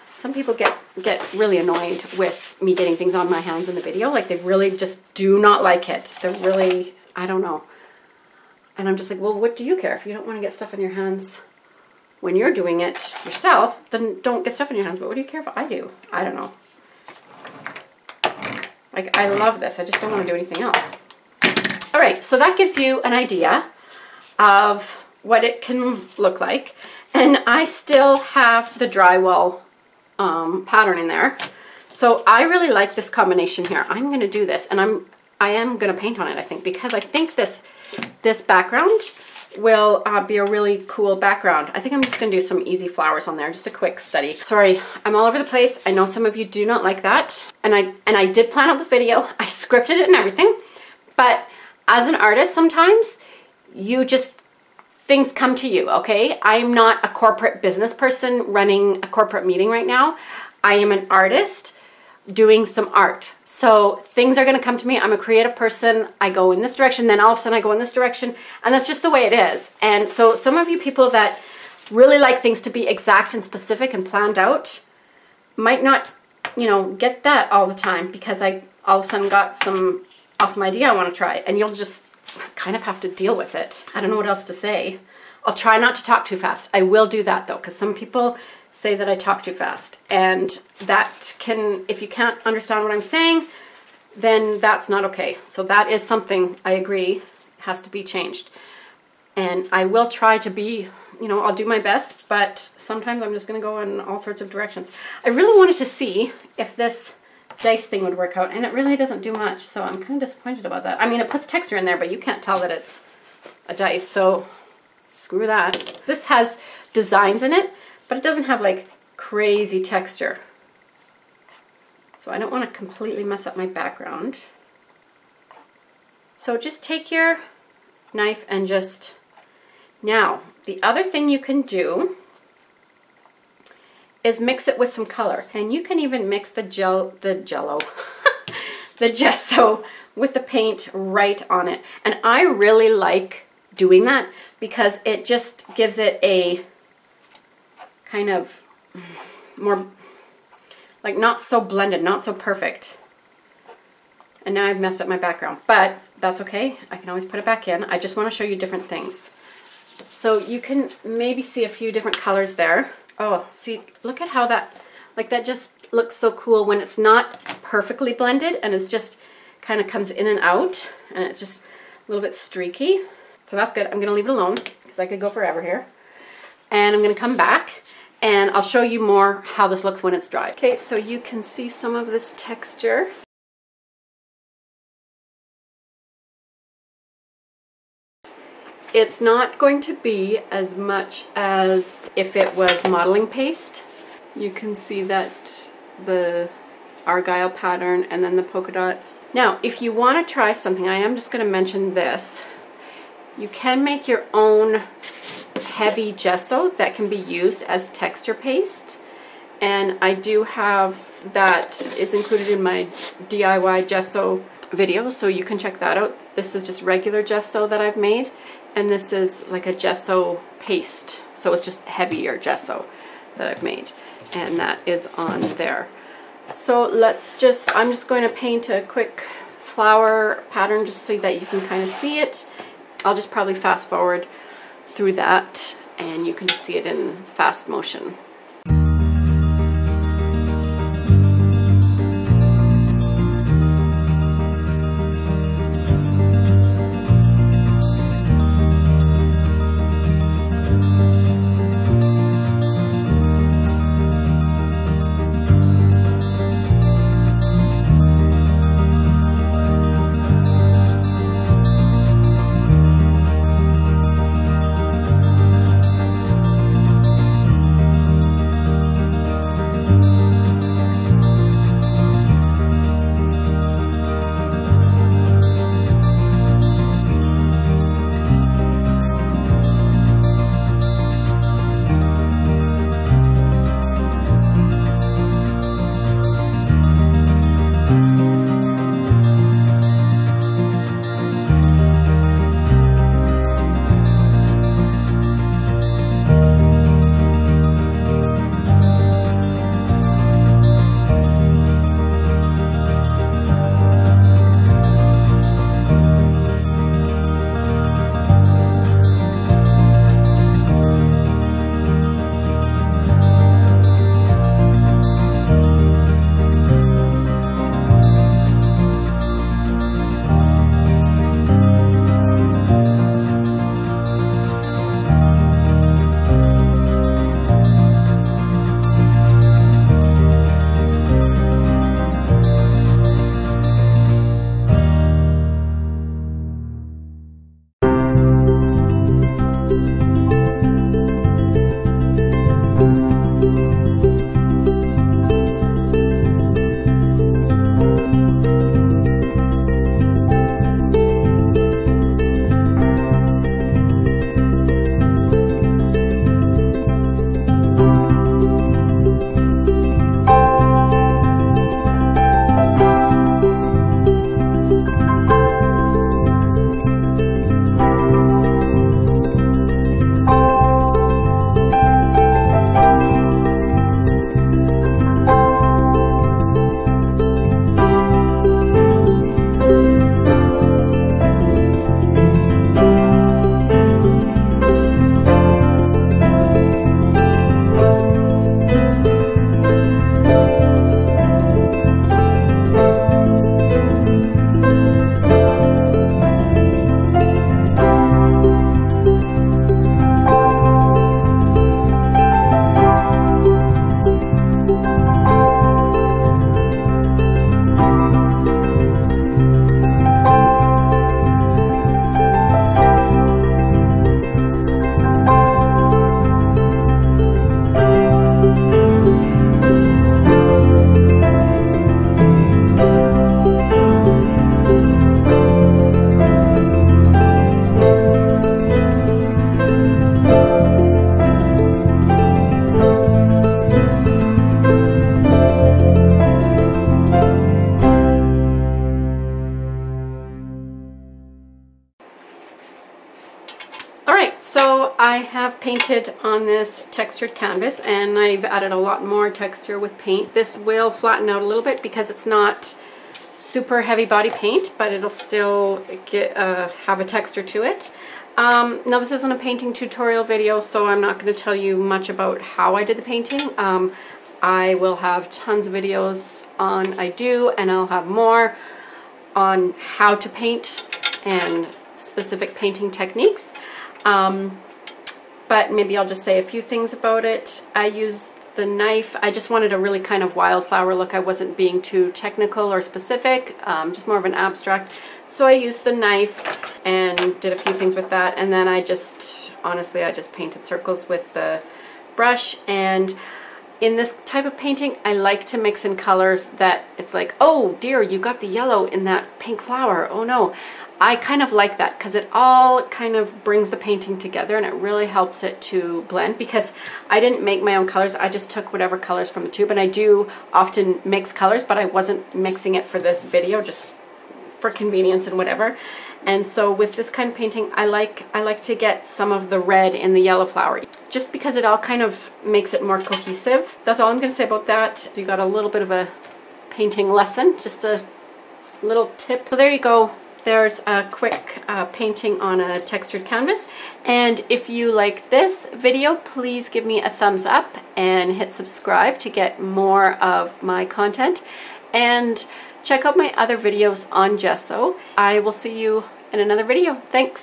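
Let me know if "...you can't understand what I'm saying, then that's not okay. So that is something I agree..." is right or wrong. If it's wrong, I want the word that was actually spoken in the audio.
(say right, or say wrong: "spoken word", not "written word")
right.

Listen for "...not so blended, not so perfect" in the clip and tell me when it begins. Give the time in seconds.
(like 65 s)
151 s.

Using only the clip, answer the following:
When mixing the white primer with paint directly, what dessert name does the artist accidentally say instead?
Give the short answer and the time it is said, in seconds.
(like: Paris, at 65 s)
Jello, at 137 s.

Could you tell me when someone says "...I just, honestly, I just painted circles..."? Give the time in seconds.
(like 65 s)
488 s.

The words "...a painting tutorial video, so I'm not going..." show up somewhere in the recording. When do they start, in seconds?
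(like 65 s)
459 s.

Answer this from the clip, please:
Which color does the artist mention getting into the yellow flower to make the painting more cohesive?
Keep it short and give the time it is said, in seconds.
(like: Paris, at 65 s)
Red, at 519 s.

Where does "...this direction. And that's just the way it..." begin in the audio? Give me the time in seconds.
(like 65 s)
67 s.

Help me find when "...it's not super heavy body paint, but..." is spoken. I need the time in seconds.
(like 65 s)
452 s.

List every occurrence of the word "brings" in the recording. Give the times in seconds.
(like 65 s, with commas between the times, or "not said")
503 s.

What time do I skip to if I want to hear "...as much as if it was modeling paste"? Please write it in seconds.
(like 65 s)
190 s.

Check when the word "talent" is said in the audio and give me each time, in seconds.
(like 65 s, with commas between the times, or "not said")
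not said.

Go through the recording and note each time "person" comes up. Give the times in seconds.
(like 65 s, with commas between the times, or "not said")
57 s, 65 s.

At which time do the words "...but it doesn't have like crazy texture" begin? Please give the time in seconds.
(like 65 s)
118 s.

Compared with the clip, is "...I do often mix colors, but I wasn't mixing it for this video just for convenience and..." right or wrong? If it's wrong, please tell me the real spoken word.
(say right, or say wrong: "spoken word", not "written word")
right.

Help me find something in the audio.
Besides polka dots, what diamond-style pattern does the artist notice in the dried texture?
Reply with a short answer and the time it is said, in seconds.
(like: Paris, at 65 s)
Argyle, at 197 s.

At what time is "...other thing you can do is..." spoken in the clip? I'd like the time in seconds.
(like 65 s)
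130 s.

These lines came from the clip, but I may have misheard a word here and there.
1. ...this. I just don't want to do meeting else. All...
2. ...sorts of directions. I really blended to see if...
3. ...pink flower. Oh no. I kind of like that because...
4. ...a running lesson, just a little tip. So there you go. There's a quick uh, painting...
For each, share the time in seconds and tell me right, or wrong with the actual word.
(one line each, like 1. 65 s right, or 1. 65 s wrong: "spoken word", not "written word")
1. 19 s wrong: "anything", not "meeting"
2. 104 s wrong: "wanted", not "blended"
3. 499 s right
4. 525 s wrong: "painting", not "running".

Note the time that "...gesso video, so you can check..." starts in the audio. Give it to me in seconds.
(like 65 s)
213 s.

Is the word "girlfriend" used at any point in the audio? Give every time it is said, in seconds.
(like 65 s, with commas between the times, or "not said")
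not said.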